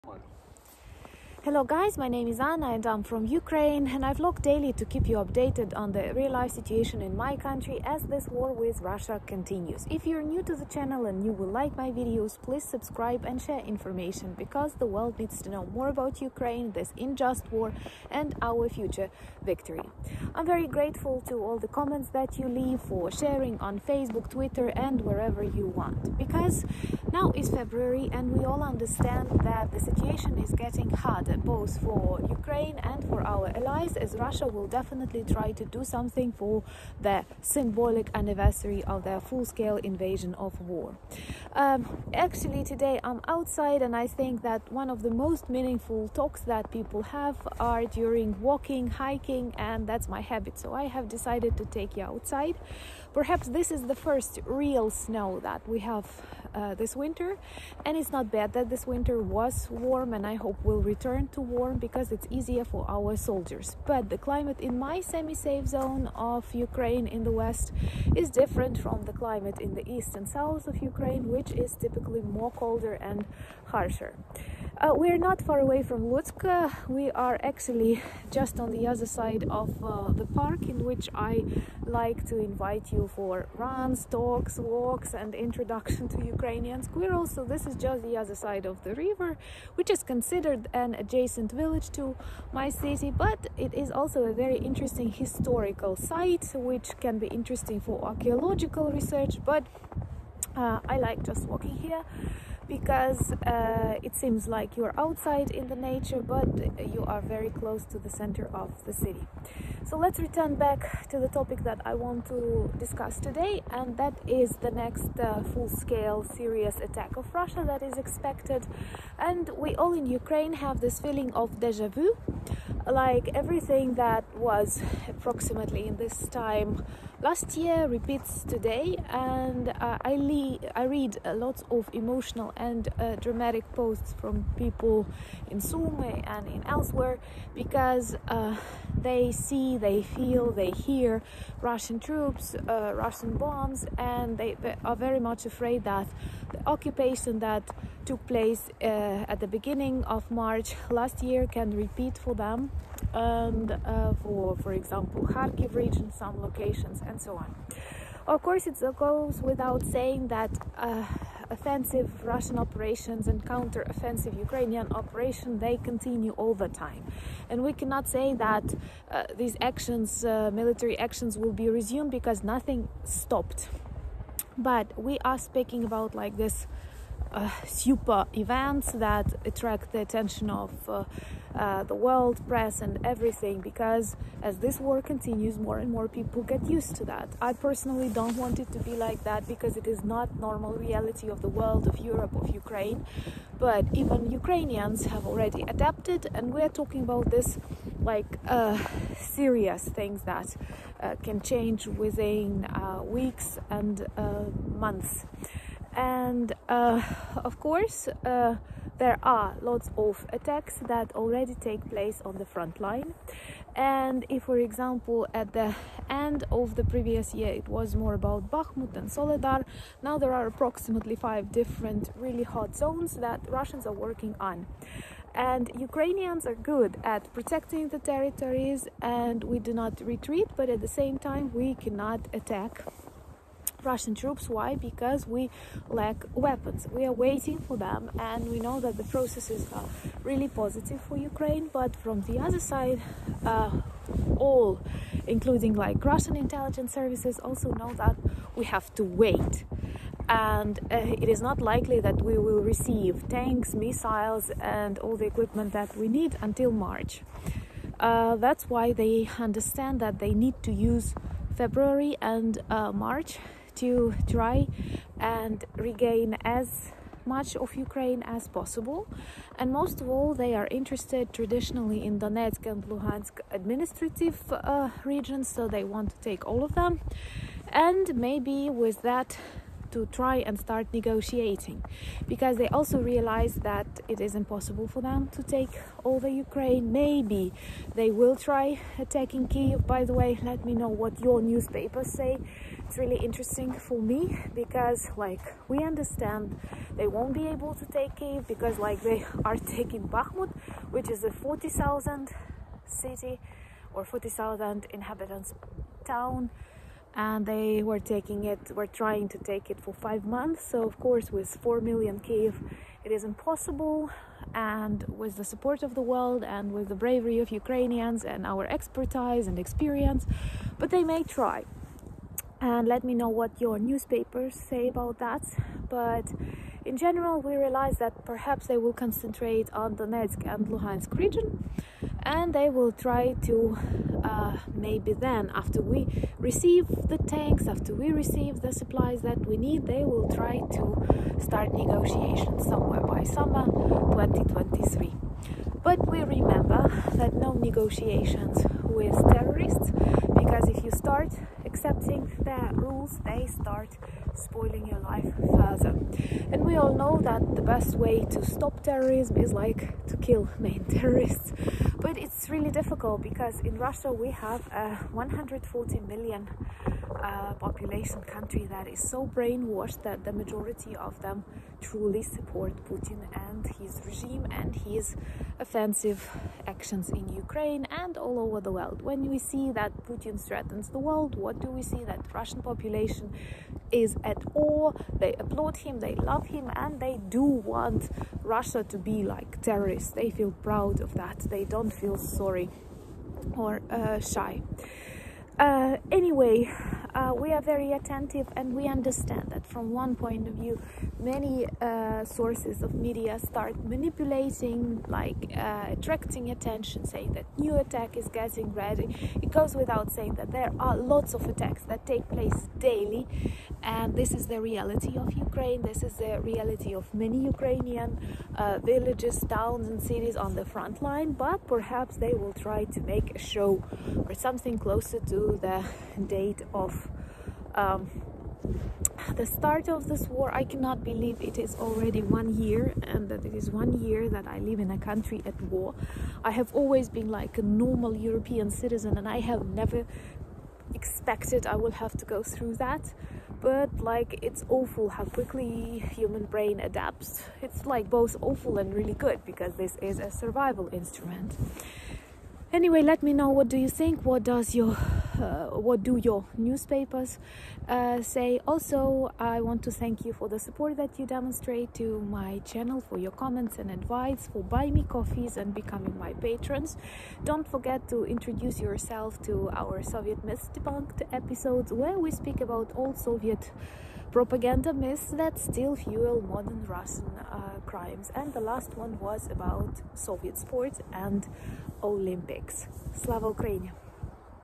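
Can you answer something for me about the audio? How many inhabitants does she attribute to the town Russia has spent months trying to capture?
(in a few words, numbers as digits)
40,000.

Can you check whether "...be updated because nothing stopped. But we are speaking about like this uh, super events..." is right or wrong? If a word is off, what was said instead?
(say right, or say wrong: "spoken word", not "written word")
wrong: "resumed", not "updated".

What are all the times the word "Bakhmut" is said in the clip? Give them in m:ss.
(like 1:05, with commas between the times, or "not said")
3:38, 5:00.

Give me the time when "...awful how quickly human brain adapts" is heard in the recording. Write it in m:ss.
7:24.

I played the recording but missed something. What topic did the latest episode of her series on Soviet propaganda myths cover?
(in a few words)
Soviet sports and Olympics.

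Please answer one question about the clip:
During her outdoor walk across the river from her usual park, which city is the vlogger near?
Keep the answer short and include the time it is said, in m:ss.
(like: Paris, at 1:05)
Lutsk, at 1:16.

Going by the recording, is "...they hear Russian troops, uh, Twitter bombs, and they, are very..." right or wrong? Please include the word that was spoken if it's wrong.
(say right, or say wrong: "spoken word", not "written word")
wrong: "Russian", not "Twitter".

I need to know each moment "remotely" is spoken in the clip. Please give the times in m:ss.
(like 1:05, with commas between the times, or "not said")
not said.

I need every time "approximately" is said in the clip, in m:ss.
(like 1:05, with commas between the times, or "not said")
2:05, 3:40.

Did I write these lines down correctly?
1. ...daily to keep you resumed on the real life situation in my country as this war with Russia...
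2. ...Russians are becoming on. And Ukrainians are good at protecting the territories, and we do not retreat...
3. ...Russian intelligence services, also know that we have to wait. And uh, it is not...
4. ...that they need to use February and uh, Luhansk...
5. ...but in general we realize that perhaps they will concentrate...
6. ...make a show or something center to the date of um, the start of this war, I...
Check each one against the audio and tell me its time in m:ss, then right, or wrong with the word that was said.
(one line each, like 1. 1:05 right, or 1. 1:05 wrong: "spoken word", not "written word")
1. 0:04 wrong: "updated", not "resumed"
2. 3:43 wrong: "working", not "becoming"
3. 4:06 right
4. 4:19 wrong: "March", not "Luhansk"
5. 5:25 right
6. 7:03 wrong: "closer", not "center".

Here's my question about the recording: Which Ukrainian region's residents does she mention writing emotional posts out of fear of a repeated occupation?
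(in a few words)
Sumy.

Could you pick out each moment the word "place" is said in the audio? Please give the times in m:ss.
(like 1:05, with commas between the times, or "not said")
2:28, 3:31, 6:52.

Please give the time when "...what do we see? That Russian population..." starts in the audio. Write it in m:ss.
6:21.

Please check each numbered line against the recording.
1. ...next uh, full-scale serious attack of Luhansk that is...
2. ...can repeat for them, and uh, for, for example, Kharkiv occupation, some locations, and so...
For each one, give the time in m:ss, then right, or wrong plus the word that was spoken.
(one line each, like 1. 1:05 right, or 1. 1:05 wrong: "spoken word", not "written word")
1. 1:54 wrong: "Russia", not "Luhansk"
2. 2:31 wrong: "region", not "occupation".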